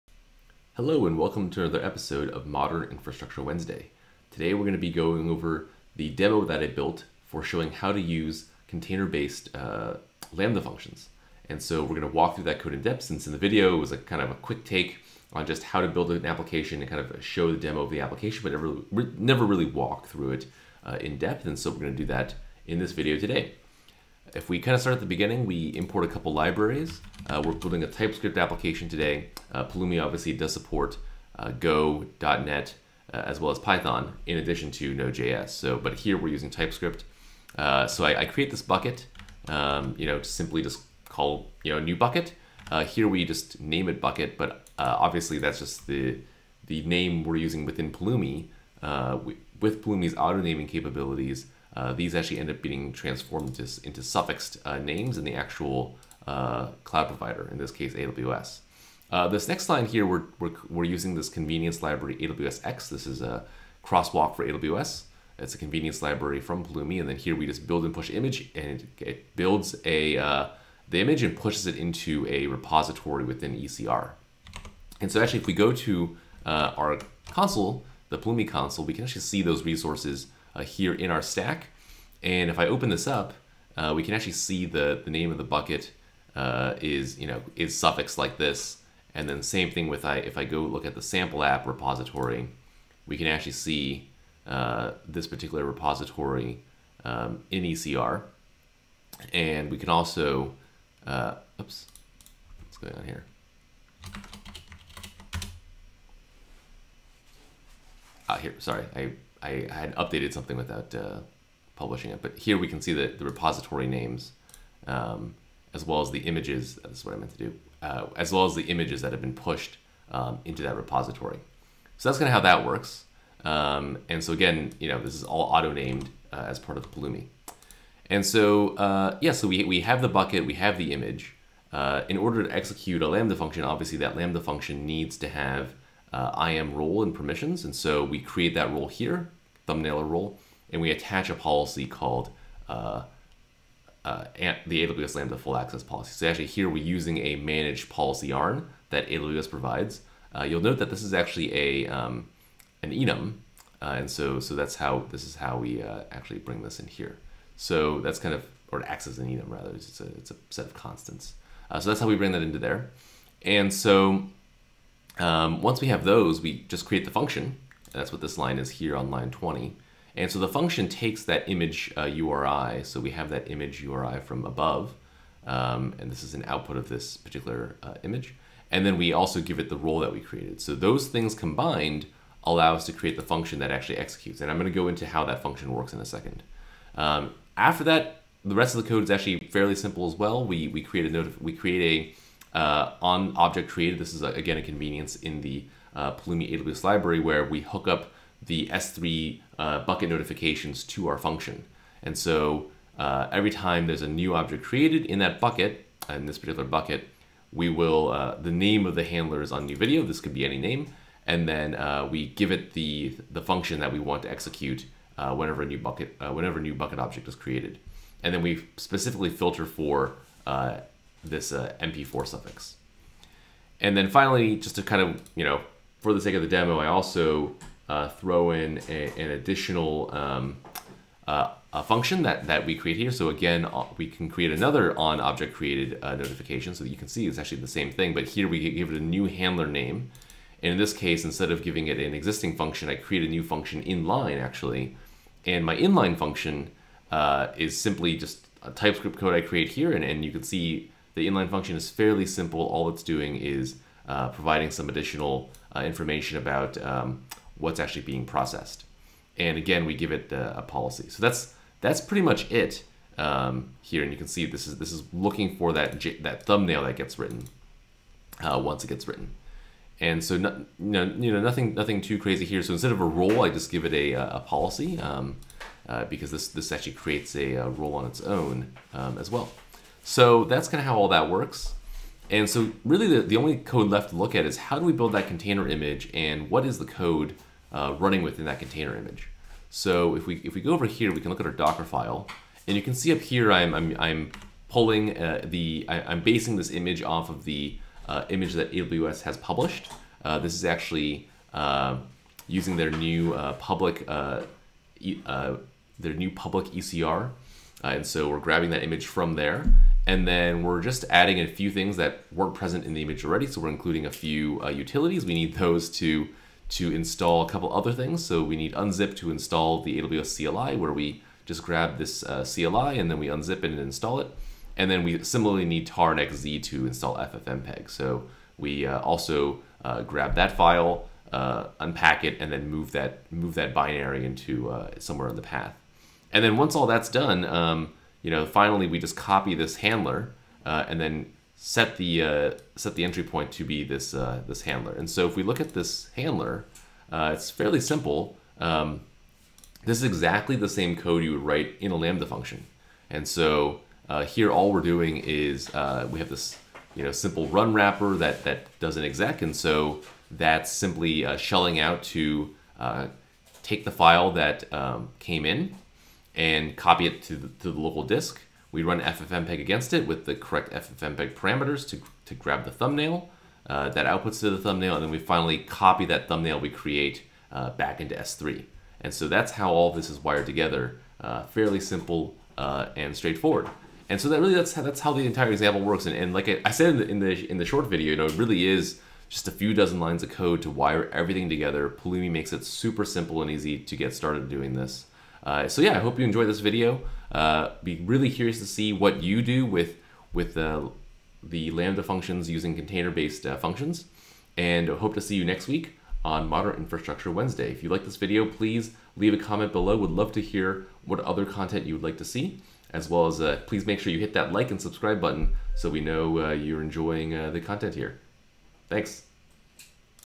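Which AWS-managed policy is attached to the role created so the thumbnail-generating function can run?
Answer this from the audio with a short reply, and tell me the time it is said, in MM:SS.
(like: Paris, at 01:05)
AWS Lambda full access, at 02:24.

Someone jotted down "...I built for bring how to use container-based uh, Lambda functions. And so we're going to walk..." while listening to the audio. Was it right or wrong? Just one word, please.
wrong.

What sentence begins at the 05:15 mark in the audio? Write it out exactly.
We need those to, to install a couple other things.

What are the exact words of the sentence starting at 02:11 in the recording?
Uh, in order to execute a Lambda function, obviously that Lambda function needs to have uh, IAM role and permissions.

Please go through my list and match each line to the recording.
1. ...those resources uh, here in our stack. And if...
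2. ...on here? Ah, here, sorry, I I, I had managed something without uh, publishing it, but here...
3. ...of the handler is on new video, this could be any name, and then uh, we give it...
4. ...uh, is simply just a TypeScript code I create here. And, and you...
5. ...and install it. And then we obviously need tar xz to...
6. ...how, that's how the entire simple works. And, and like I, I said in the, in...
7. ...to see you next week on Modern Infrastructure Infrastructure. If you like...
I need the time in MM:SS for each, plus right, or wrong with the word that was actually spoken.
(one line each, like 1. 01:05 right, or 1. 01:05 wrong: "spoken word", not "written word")
1. 01:19 right
2. 01:42 wrong: "updated", not "managed"
3. 03:28 right
4. 04:07 right
5. 05:23 wrong: "similarly", not "obviously"
6. 06:24 wrong: "example", not "simple"
7. 06:45 wrong: "Wednesday", not "Infrastructure".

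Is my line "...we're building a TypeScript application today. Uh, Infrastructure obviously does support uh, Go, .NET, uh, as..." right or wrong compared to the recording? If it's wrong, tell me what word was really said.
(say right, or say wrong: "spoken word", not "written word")
wrong: "Pulumi", not "Infrastructure".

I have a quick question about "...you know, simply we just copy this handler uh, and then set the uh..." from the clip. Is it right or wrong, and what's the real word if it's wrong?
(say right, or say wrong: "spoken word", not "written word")
wrong: "finally", not "simply".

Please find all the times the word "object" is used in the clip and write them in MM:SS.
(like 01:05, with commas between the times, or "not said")
03:13, 03:24, 03:36, 03:55.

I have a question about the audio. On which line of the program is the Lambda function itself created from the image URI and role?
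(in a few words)
20.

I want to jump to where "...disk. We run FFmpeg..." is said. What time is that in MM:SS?
06:08.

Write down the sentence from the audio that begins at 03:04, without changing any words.
And I'm gonna go into how that function works in a second.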